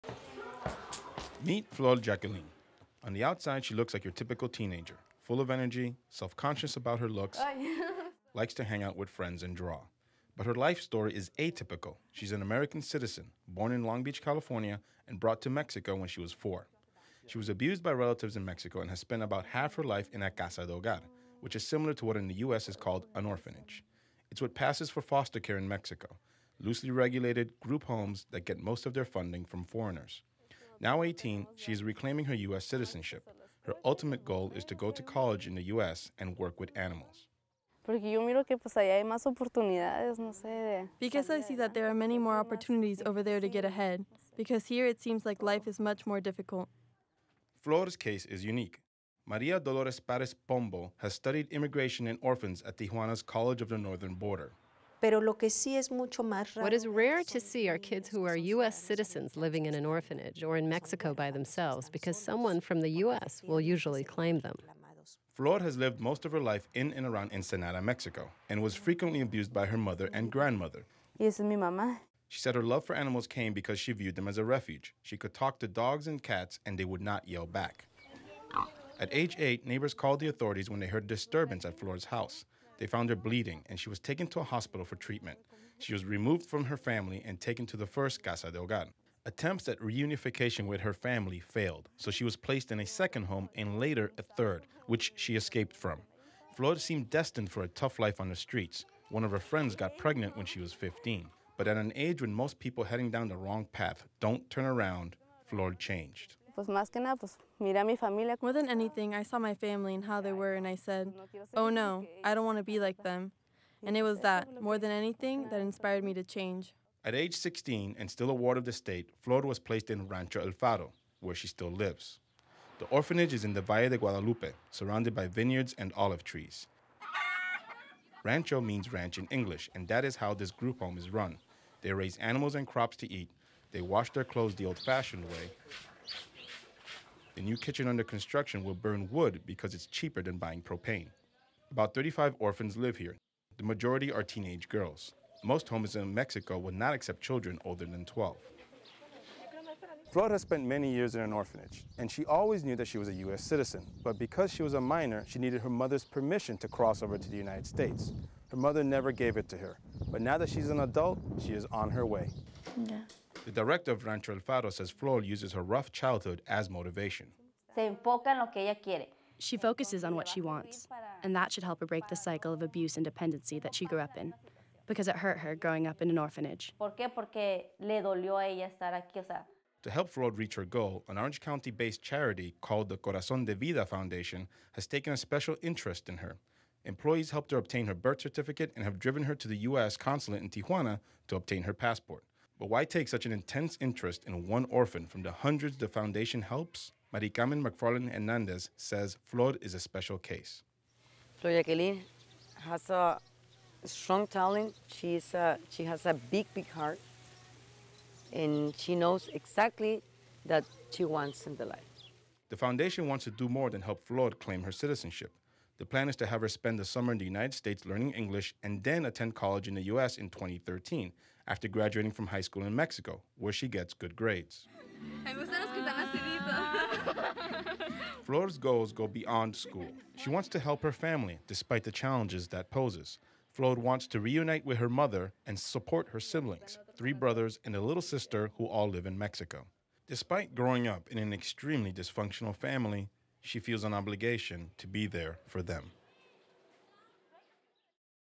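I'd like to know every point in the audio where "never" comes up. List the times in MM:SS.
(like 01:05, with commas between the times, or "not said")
02:38.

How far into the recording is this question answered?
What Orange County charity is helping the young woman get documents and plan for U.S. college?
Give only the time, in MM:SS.
03:02.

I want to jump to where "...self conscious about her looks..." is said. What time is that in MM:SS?
00:06.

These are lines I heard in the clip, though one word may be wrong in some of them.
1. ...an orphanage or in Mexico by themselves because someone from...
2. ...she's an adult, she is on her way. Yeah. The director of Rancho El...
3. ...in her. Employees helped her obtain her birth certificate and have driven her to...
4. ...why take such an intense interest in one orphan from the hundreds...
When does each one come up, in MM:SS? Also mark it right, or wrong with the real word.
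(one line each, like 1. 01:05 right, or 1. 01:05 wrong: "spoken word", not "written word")
1. 00:59 right
2. 02:40 right
3. 03:06 right
4. 03:12 right.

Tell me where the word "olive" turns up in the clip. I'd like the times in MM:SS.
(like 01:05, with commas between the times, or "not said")
02:05.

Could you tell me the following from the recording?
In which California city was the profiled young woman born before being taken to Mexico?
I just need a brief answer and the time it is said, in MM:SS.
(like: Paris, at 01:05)
Long Beach, at 00:13.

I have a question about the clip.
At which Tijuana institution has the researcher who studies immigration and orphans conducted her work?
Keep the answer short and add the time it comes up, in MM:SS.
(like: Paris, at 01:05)
College of the Northern Border, at 00:53.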